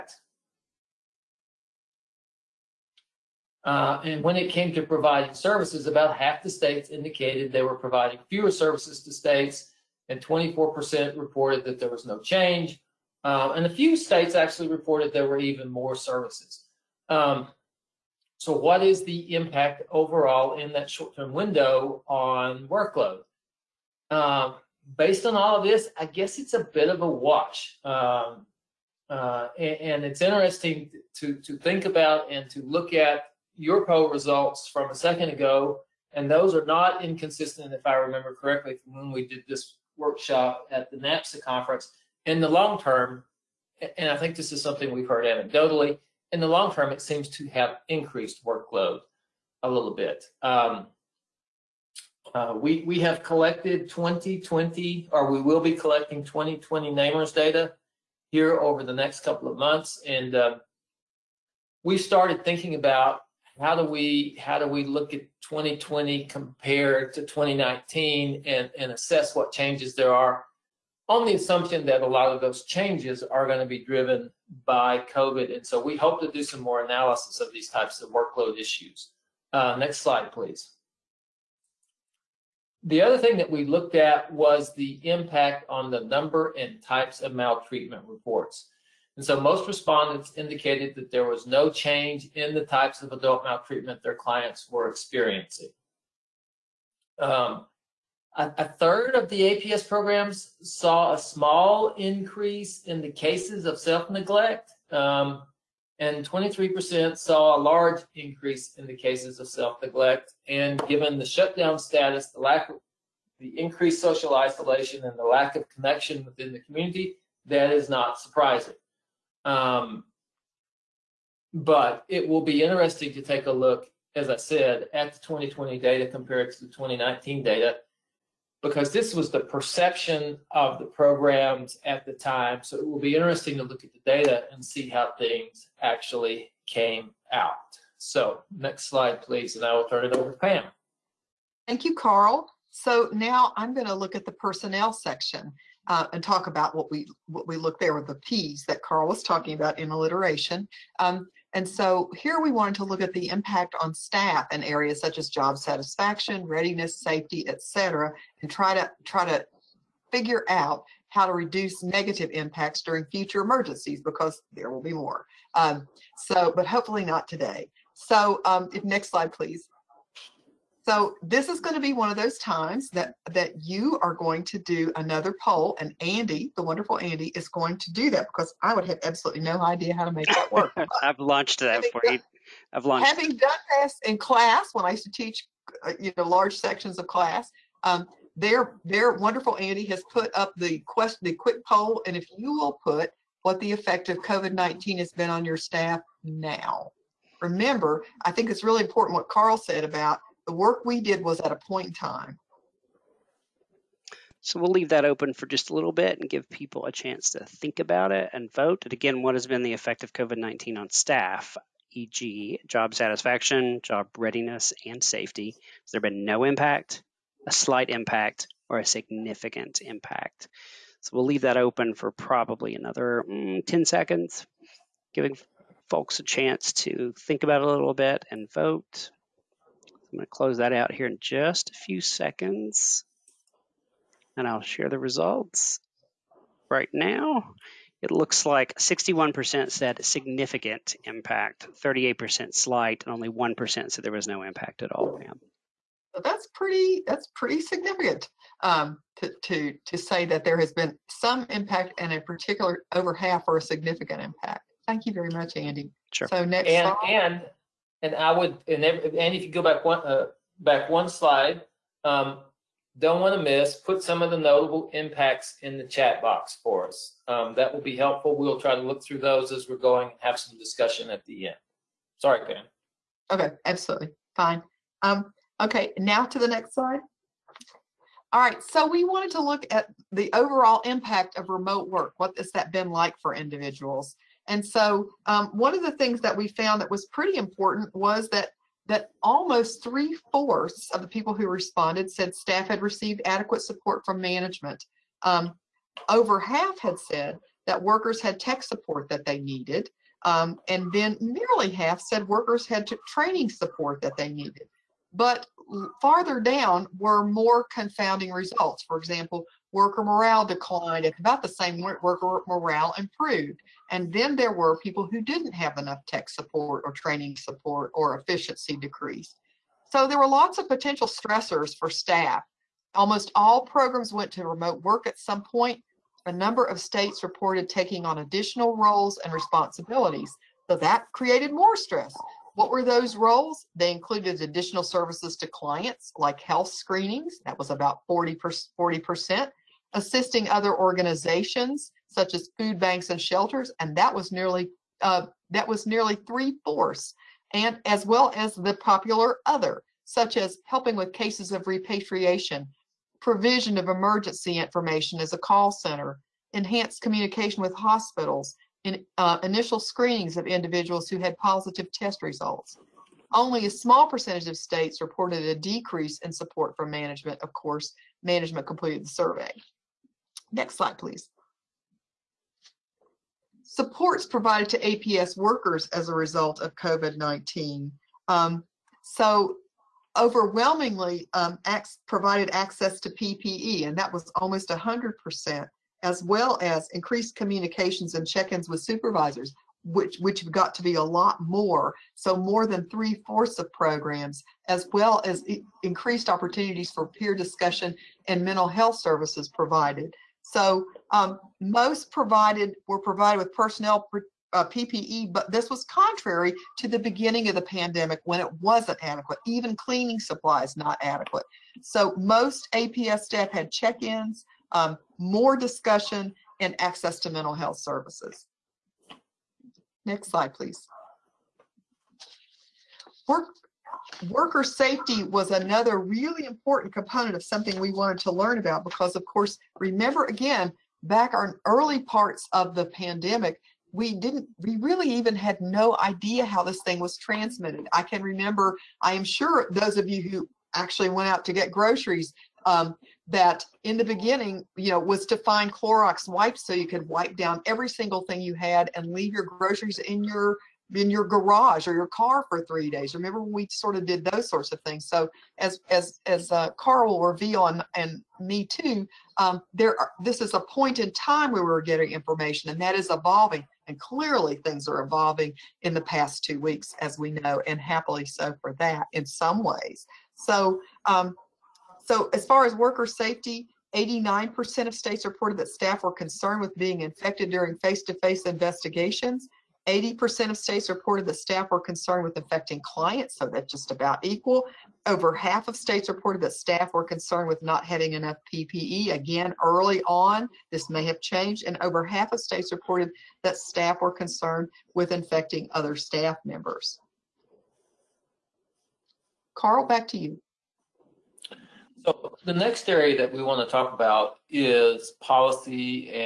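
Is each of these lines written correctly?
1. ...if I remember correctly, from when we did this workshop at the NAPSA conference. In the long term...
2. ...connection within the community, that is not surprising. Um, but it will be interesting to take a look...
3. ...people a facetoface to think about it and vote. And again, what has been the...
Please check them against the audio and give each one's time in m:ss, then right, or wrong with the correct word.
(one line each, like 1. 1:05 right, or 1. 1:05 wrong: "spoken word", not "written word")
1. 0:37 right
2. 1:55 right
3. 3:26 wrong: "chance", not "facetoface".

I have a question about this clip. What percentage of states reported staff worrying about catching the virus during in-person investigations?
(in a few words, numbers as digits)
89%.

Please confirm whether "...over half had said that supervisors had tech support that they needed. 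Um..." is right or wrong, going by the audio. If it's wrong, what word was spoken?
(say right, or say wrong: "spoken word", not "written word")
wrong: "workers", not "supervisors".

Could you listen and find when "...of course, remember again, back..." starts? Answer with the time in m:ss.
7:09.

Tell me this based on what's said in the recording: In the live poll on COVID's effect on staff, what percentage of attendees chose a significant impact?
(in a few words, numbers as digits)
61%.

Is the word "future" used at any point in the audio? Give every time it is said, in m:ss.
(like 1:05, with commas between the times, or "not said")
2:43.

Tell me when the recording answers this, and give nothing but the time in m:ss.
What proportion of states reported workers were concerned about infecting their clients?
7:59.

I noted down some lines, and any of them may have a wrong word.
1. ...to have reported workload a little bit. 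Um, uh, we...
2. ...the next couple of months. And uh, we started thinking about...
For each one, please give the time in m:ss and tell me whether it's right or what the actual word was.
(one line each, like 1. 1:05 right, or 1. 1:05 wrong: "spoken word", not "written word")
1. 0:47 wrong: "increased", not "reported"
2. 0:58 right.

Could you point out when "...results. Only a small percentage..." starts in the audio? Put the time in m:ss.
6:02.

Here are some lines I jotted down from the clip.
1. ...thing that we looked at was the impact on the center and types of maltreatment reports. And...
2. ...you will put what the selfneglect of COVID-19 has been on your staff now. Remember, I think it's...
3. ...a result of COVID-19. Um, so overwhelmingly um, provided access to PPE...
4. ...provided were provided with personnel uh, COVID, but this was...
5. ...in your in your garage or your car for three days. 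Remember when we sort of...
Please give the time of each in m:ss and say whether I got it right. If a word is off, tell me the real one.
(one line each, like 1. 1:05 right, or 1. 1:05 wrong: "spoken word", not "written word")
1. 1:23 wrong: "number", not "center"
2. 3:12 wrong: "effect", not "selfneglect"
3. 6:16 right
4. 6:42 wrong: "PPE", not "COVID"
5. 7:29 right.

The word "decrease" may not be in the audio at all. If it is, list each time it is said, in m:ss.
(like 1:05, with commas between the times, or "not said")
5:18, 6:05.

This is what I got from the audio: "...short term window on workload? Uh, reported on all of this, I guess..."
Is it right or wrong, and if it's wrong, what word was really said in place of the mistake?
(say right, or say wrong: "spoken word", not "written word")
wrong: "based", not "reported".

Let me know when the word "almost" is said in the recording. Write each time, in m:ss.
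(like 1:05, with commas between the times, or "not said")
4:49, 5:22, 6:24.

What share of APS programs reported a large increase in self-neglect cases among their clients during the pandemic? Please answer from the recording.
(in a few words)
23%.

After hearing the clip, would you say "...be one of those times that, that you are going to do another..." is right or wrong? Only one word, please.
right.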